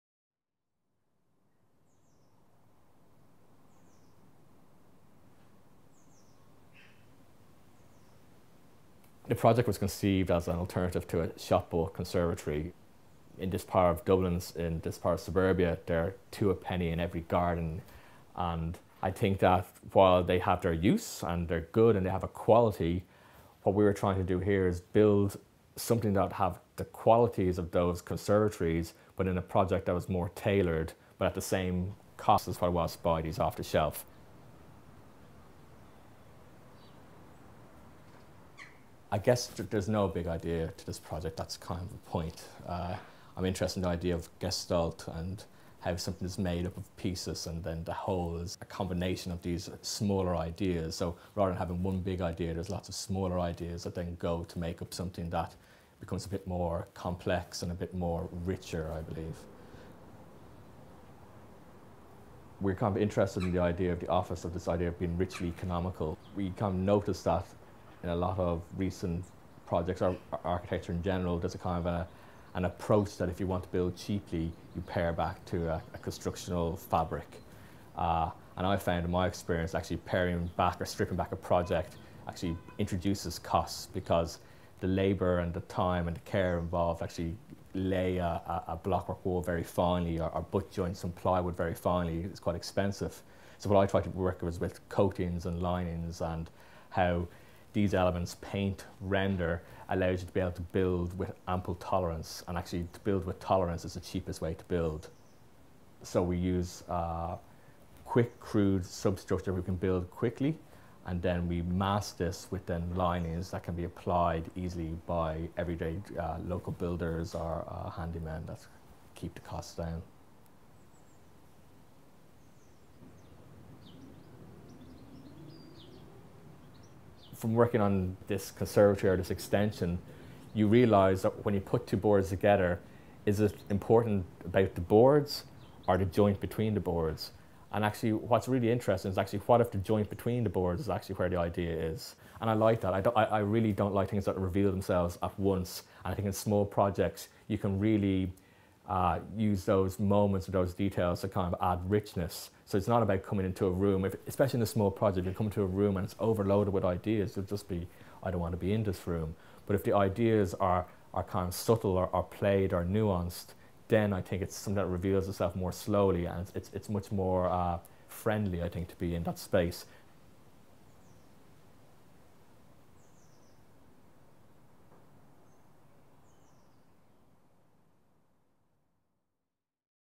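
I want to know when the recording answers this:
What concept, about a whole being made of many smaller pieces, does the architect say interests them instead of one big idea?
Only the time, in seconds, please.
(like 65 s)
44 s.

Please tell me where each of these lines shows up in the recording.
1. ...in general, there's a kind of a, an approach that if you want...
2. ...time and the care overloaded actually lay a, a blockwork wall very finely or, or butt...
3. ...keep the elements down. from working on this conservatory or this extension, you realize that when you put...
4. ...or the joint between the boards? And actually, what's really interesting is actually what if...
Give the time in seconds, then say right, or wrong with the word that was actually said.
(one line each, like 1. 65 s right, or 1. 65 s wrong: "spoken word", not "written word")
1. 70 s right
2. 85 s wrong: "involved", not "overloaded"
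3. 119 s wrong: "costs", not "elements"
4. 135 s right.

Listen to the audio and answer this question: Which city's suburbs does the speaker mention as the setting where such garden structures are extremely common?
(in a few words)
Dublin.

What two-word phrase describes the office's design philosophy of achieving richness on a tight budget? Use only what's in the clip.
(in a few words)
richly economical.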